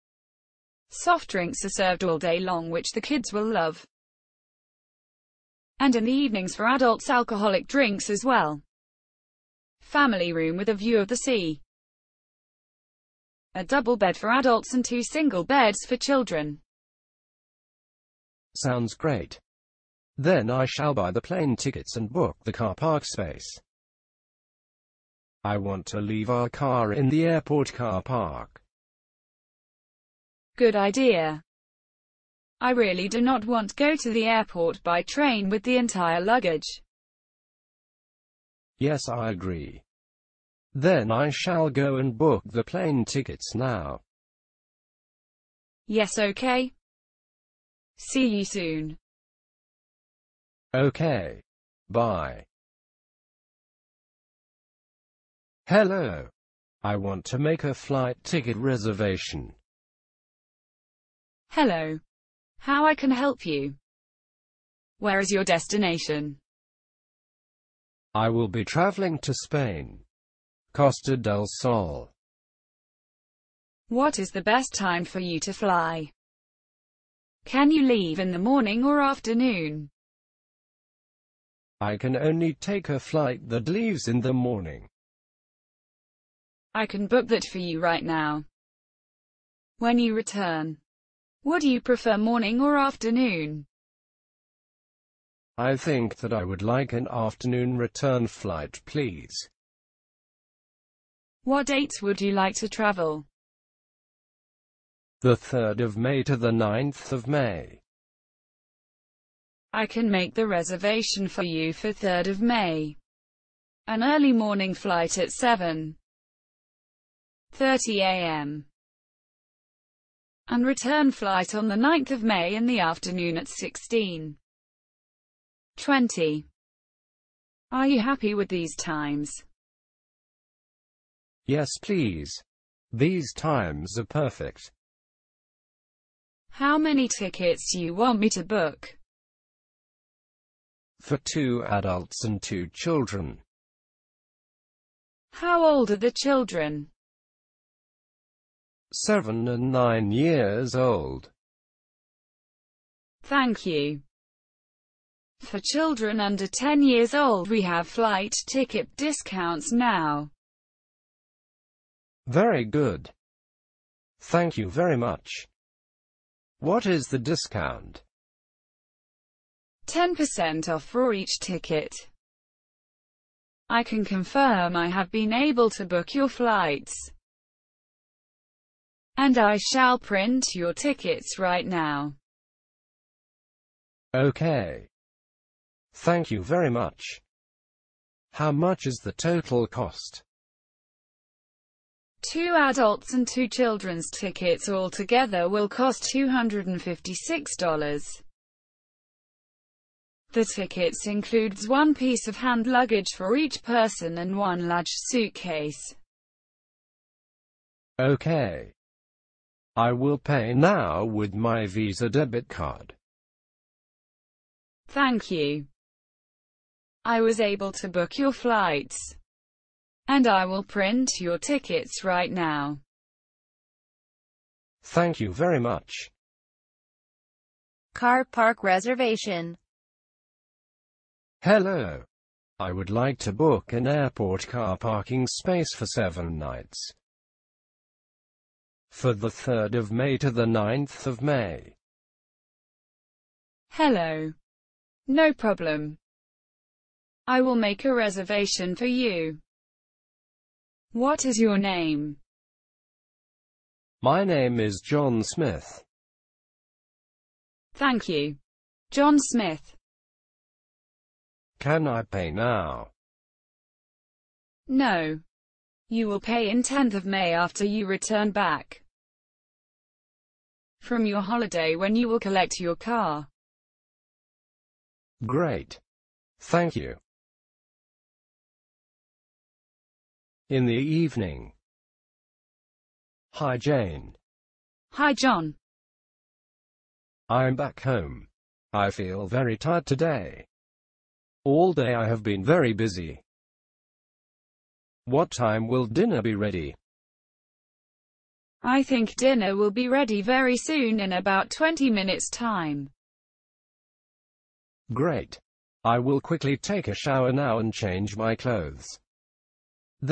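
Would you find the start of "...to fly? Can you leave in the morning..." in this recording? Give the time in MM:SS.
01:15.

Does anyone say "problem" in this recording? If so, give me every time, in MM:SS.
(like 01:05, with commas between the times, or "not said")
04:05.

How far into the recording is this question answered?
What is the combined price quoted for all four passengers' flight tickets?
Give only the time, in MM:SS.
03:16.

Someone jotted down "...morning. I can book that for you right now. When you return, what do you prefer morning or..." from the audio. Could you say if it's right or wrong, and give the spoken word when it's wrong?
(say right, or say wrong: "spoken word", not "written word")
right.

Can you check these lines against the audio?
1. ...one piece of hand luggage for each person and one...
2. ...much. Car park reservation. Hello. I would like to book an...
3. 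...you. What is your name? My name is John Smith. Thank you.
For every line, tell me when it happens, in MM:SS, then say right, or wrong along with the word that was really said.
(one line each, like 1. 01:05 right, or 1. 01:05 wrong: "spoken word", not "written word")
1. 03:21 right
2. 03:45 right
3. 04:08 right.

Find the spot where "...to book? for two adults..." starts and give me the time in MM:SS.
02:18.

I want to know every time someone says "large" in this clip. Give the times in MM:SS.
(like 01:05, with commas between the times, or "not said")
03:24.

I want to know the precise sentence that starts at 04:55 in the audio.
What time will dinner be ready?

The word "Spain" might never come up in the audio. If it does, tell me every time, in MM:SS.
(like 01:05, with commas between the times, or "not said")
01:09.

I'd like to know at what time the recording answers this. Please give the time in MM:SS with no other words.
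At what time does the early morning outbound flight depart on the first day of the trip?
01:55.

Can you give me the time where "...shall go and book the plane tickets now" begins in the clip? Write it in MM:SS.
00:41.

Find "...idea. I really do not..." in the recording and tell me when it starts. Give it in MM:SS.
00:30.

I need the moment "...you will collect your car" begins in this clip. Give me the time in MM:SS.
04:31.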